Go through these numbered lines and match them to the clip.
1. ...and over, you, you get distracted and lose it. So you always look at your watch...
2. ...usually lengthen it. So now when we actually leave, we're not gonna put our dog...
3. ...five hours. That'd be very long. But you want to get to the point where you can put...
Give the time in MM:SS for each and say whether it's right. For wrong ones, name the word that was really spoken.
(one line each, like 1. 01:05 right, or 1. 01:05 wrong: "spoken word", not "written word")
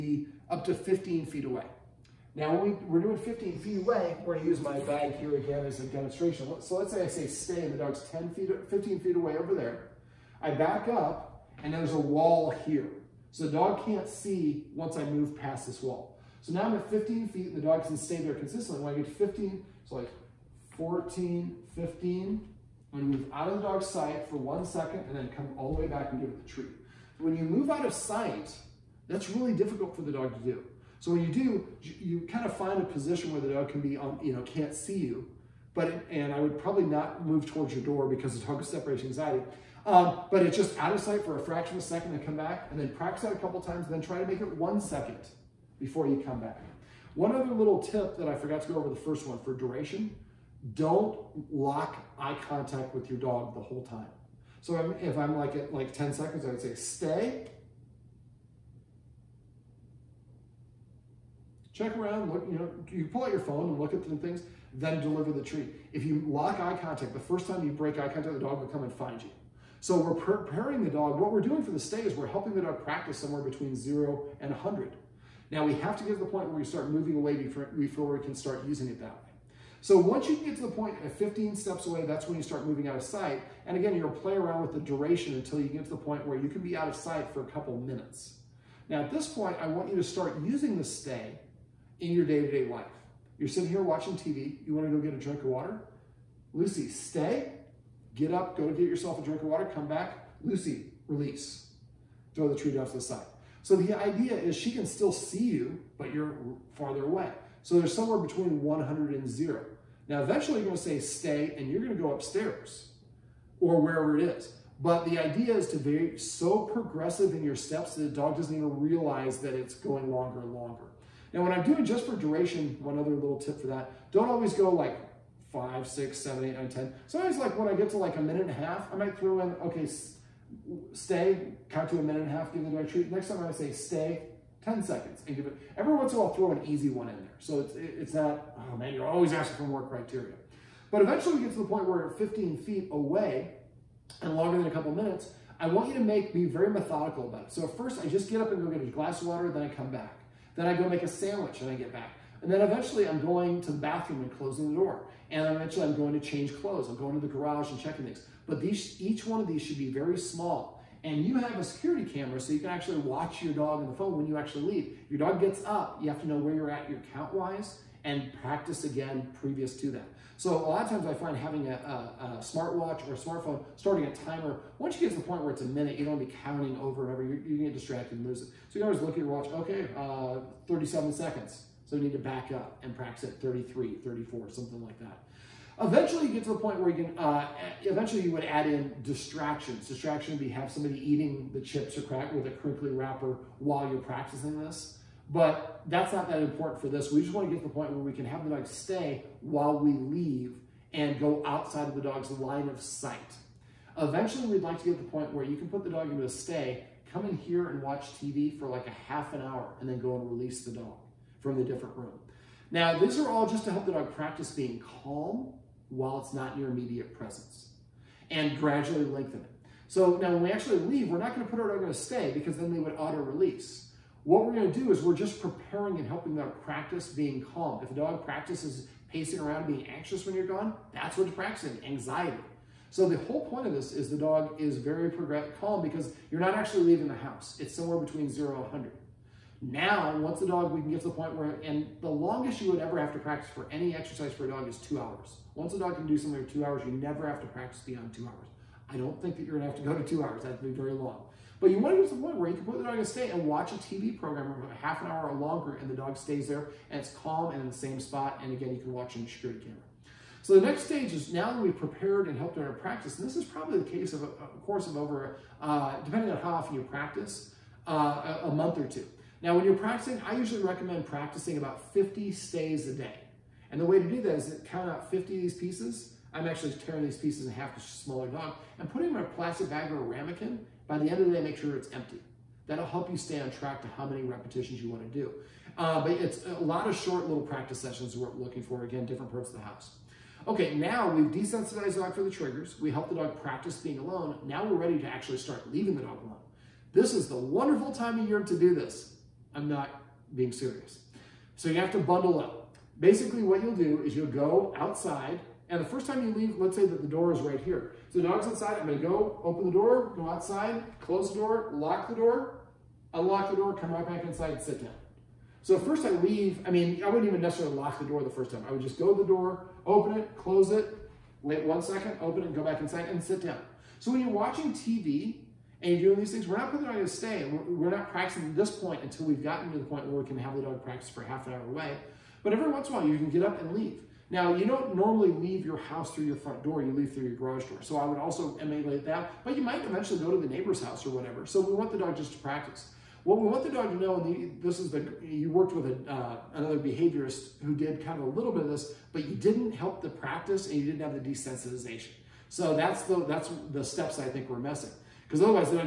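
1. 02:57 right
2. 03:38 wrong: "gradually", not "usually"
3. 04:10 wrong: "two", not "five".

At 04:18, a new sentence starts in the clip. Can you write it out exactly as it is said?
And again, you can watch a security camera.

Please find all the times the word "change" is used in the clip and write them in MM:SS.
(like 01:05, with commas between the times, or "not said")
02:36.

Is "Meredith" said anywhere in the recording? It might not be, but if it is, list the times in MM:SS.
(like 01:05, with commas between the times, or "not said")
not said.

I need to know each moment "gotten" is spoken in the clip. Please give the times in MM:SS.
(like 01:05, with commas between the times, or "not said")
05:29.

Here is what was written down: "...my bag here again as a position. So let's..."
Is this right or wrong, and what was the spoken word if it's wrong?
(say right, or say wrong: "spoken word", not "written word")
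wrong: "demonstration", not "position".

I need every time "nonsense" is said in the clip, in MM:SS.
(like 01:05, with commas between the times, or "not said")
not said.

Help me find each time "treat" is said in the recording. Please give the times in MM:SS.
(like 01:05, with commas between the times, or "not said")
00:26, 01:05, 01:42, 02:12.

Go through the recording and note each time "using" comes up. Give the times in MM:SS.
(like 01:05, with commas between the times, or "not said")
01:18, 01:30.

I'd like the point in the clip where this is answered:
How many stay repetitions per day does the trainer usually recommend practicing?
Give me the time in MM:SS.
04:31.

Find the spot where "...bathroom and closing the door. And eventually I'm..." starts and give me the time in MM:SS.
02:33.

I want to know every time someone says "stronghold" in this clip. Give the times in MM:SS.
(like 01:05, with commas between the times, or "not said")
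not said.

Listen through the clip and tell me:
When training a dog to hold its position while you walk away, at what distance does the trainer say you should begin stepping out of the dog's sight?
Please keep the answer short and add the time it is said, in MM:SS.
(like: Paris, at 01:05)
15 steps, at 01:21.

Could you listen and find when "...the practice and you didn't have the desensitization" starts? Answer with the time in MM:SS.
05:50.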